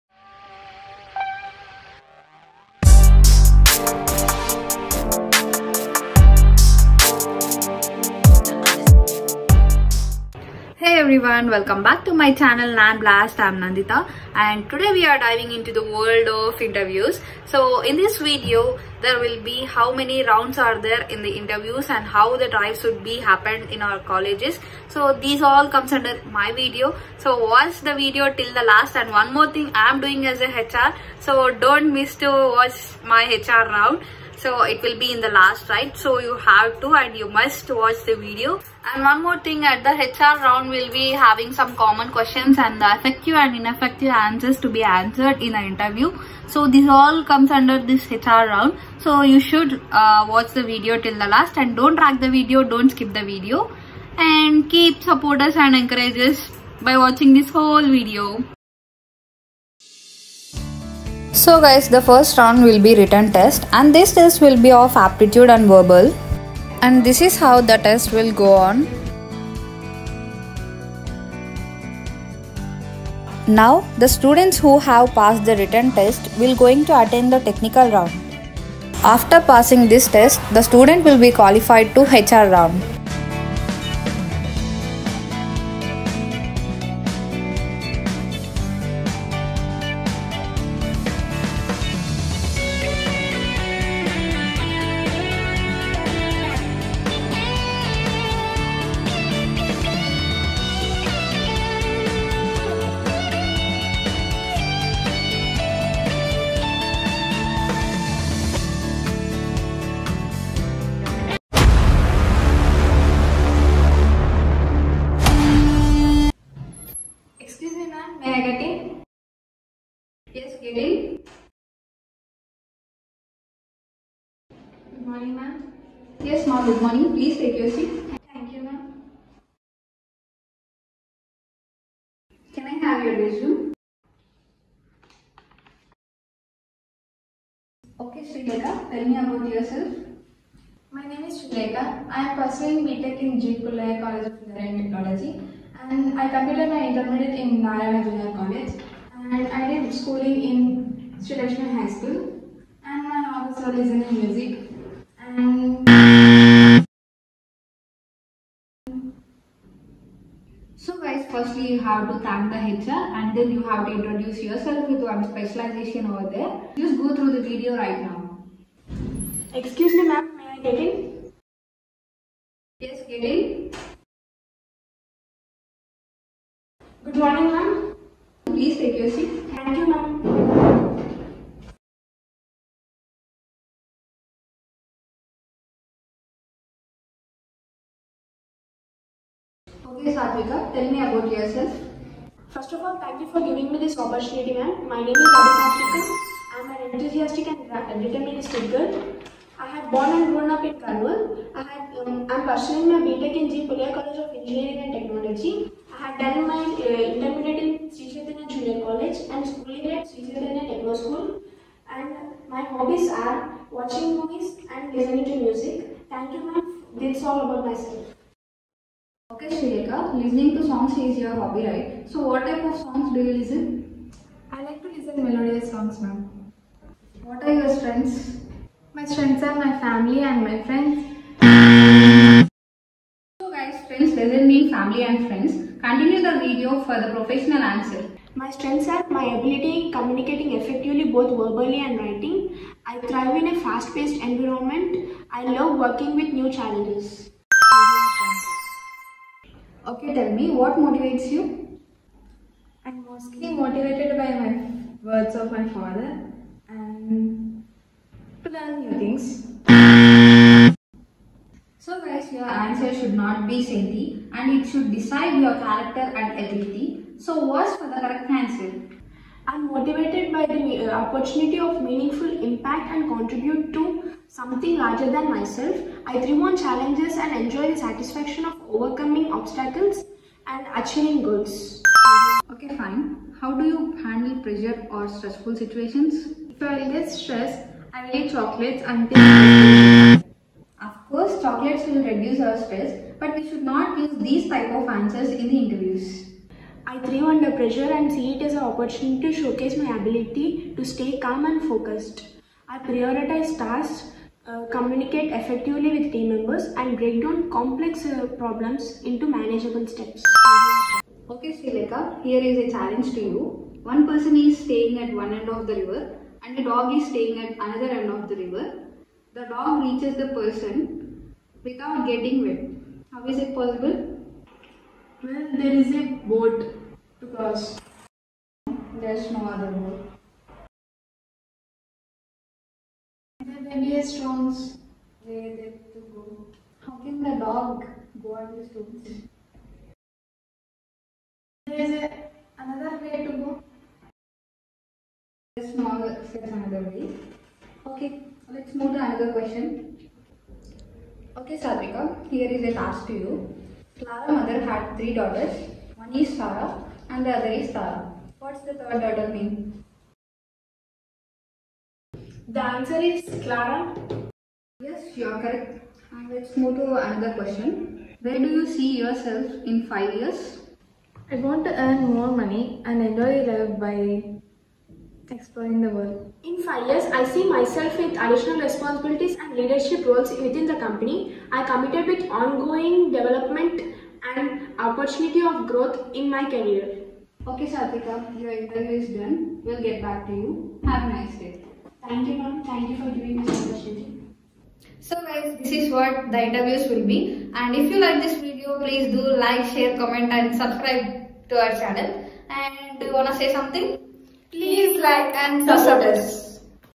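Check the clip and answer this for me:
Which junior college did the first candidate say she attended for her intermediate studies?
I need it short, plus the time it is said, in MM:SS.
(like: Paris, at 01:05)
Narayana Junior College, at 02:27.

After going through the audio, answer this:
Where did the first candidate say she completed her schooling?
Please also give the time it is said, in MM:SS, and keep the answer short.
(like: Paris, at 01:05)
Sri Lakshmi High School, at 02:31.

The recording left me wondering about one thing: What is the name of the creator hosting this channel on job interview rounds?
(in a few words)
Nandita.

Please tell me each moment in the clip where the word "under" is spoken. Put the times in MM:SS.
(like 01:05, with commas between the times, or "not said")
00:25, 00:47, 04:57.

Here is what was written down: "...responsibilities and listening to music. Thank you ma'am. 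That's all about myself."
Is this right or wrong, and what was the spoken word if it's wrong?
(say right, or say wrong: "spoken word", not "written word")
wrong: "movies", not "responsibilities".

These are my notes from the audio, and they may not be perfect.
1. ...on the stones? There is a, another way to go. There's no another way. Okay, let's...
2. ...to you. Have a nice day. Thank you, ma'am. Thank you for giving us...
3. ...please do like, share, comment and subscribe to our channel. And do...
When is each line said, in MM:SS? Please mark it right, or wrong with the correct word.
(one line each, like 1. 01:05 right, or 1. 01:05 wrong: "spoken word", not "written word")
1. 05:38 right
2. 06:30 right
3. 06:38 right.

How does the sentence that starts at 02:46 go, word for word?
Just go through the video right now.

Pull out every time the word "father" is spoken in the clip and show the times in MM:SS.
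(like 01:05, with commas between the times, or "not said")
02:33, 04:15.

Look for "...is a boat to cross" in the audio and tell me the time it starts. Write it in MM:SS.
05:25.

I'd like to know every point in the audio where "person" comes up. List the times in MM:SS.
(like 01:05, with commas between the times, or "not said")
05:14, 05:20.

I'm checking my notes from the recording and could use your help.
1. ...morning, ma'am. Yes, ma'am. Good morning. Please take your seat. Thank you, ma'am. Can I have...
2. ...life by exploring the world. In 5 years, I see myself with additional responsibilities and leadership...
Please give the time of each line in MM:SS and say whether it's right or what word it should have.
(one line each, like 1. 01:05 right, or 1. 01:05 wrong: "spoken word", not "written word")
1. 02:05 right
2. 06:13 right.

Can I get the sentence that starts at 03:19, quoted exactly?
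I had born and grown up in Karnal.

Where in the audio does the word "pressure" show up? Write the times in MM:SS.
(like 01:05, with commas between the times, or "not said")
04:44, 04:57.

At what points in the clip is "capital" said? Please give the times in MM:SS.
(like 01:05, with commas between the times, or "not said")
not said.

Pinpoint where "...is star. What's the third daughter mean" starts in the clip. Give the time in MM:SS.
05:57.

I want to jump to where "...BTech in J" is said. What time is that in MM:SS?
02:22.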